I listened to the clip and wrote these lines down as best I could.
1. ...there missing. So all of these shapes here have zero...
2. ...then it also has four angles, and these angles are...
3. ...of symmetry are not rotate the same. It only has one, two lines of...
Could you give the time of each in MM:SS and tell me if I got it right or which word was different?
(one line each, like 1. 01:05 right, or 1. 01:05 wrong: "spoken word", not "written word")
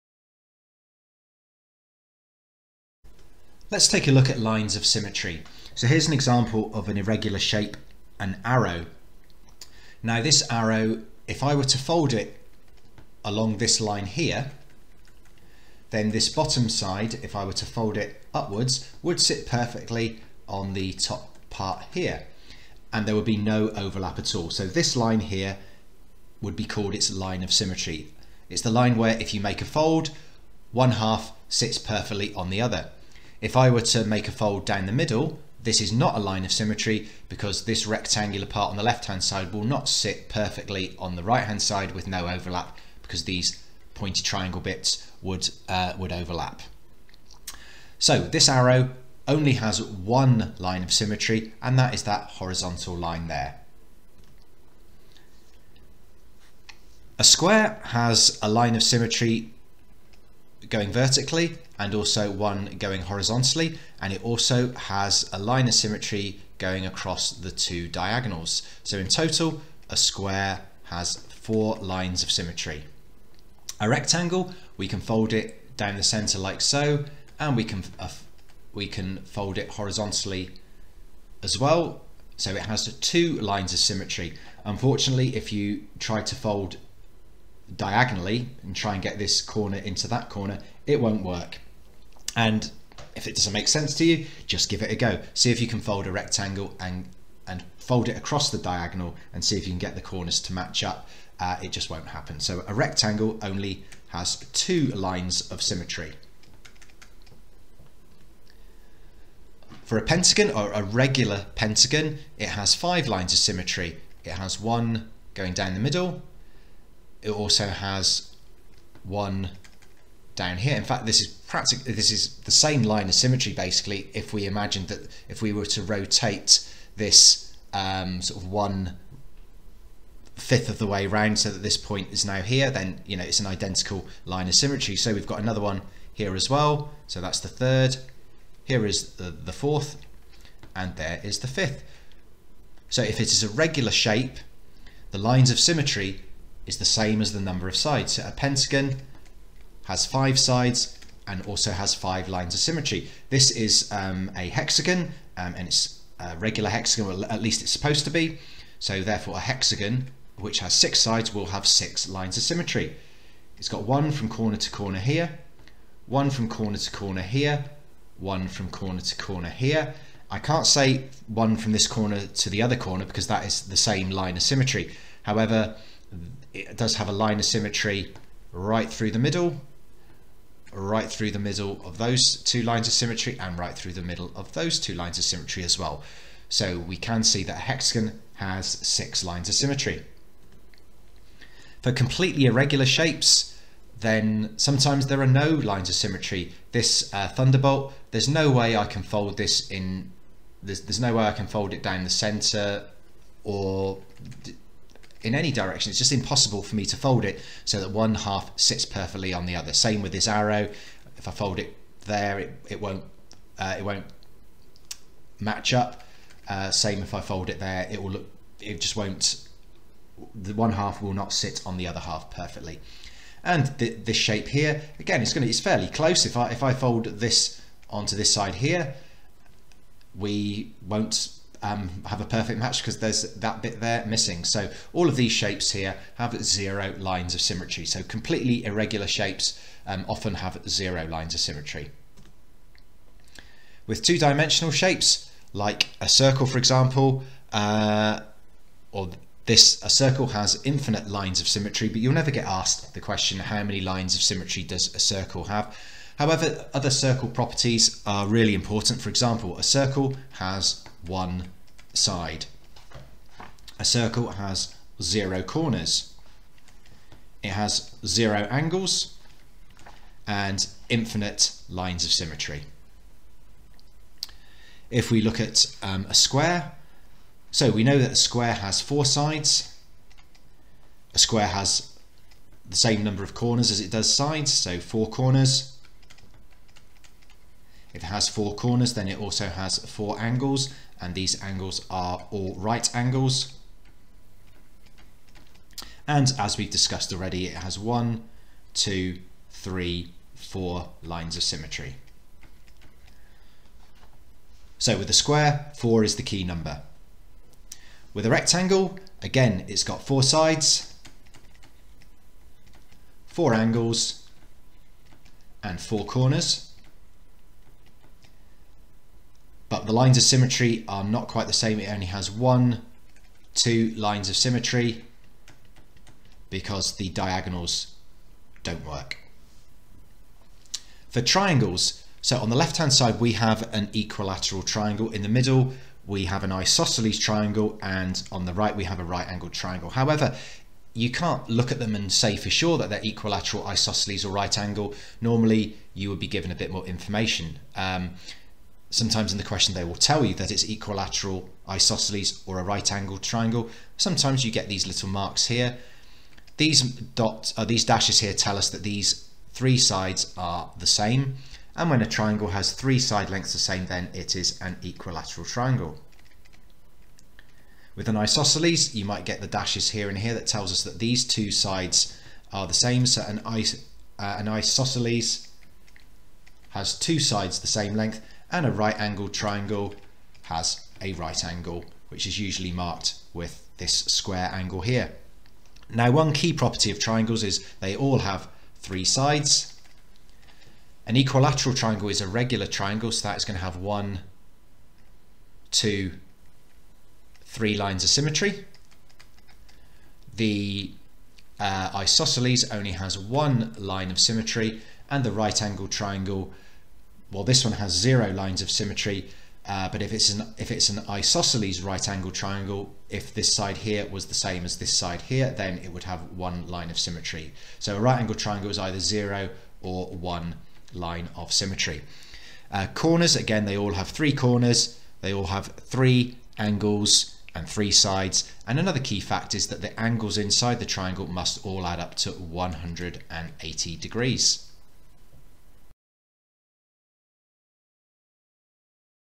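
1. 03:53 right
2. 04:48 right
3. 05:20 wrong: "quite", not "rotate".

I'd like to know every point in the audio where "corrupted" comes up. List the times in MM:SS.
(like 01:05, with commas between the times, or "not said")
not said.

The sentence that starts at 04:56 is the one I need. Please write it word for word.
And as we've discussed already, it has one, two, three, four lines of symmetry.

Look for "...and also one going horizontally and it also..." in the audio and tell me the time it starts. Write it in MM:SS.
01:01.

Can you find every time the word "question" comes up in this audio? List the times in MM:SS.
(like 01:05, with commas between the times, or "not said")
04:13, 05:49.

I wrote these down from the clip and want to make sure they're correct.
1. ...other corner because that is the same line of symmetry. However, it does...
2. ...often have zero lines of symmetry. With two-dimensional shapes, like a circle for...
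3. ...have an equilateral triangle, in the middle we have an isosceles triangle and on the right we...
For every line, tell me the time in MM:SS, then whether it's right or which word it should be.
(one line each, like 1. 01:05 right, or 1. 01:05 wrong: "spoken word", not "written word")
1. 02:52 right
2. 04:00 right
3. 05:33 right.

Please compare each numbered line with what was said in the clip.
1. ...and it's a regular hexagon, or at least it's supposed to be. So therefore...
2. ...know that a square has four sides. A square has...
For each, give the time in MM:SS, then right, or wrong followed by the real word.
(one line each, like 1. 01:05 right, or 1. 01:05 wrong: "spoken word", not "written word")
1. 02:35 right
2. 04:37 right.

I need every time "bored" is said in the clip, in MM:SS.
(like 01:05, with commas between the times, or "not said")
not said.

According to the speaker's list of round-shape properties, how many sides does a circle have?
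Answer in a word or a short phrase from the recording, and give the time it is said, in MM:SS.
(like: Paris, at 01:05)
1, at 04:21.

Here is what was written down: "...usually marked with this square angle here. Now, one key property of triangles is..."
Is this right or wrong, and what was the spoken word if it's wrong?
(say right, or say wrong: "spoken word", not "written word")
right.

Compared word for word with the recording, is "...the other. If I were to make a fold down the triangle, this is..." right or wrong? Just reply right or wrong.
wrong.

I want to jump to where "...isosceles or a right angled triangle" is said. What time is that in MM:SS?
05:51.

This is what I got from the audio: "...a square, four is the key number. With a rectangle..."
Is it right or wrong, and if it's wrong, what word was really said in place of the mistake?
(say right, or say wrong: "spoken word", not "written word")
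right.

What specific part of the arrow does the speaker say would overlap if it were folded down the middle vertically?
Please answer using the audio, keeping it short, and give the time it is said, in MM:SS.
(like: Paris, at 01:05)
pointy triangle bits, at 00:43.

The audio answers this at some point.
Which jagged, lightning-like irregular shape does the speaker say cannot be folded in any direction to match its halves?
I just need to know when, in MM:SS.
03:17.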